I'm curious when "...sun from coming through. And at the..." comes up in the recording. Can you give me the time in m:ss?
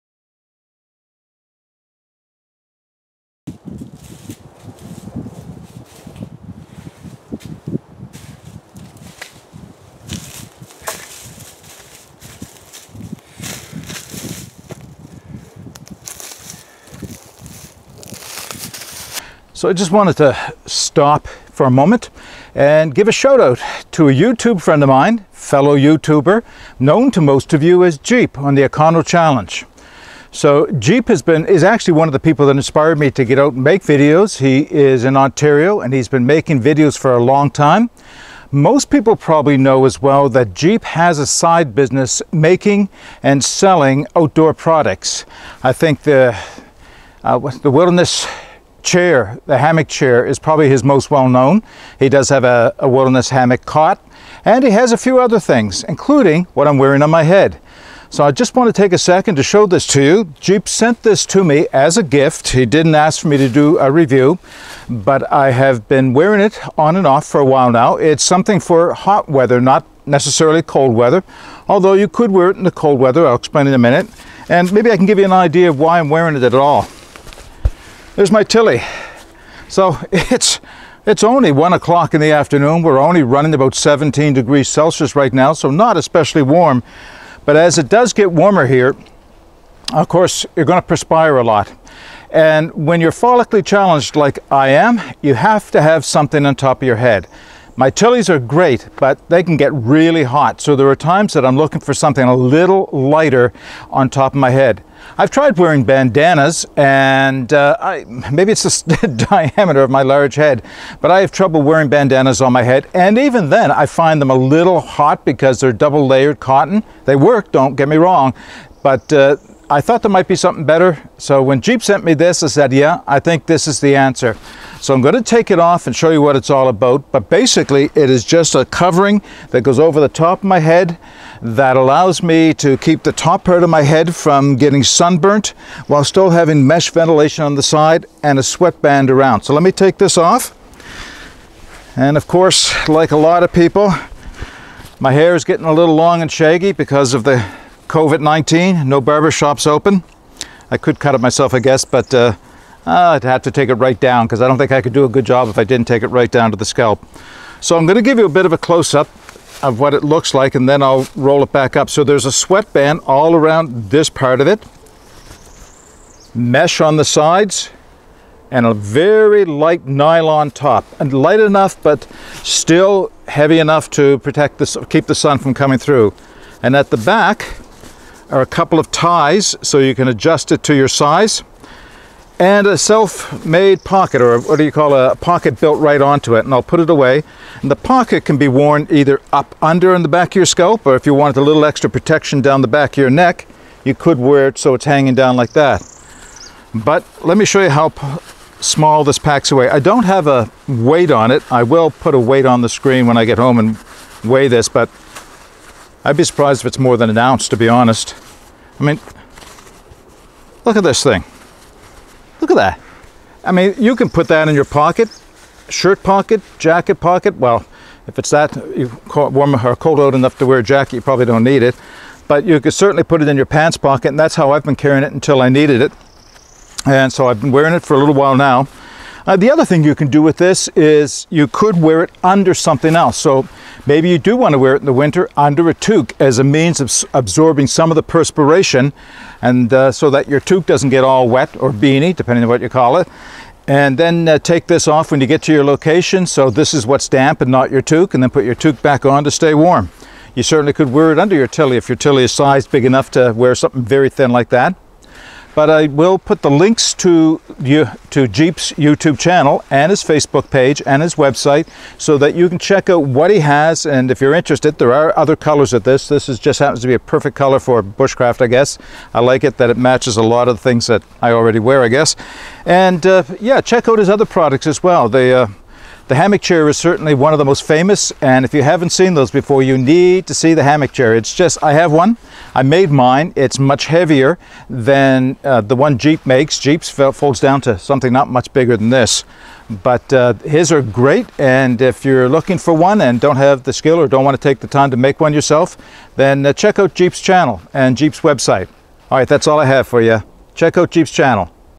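2:55.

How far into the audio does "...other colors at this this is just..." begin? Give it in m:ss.
4:25.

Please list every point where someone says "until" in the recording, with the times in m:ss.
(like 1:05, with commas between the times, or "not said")
3:45.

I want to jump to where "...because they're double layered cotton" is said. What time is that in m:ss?
1:55.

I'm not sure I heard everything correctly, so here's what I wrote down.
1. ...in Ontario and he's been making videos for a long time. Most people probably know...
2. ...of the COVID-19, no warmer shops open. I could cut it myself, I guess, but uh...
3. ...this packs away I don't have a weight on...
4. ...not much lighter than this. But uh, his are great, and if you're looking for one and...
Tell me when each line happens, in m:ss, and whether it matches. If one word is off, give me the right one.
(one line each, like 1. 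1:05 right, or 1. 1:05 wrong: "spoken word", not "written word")
1. 0:35 right
2. 2:27 wrong: "barber", not "warmer"
3. 3:19 right
4. 4:48 wrong: "bigger", not "lighter".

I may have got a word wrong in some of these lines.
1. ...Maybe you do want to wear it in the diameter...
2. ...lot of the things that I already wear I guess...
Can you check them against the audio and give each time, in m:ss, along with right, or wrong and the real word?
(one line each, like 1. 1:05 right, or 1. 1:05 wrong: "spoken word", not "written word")
1. 3:53 wrong: "winter", not "diameter"
2. 4:30 right.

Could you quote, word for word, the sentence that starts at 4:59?
All right, that's all I have for you.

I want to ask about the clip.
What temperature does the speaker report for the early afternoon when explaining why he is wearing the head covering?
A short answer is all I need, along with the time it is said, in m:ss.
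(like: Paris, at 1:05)
17 degrees Celsius, at 1:23.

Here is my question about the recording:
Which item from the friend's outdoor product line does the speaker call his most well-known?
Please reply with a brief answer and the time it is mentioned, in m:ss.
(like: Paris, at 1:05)
The Wilderness chair, at 0:47.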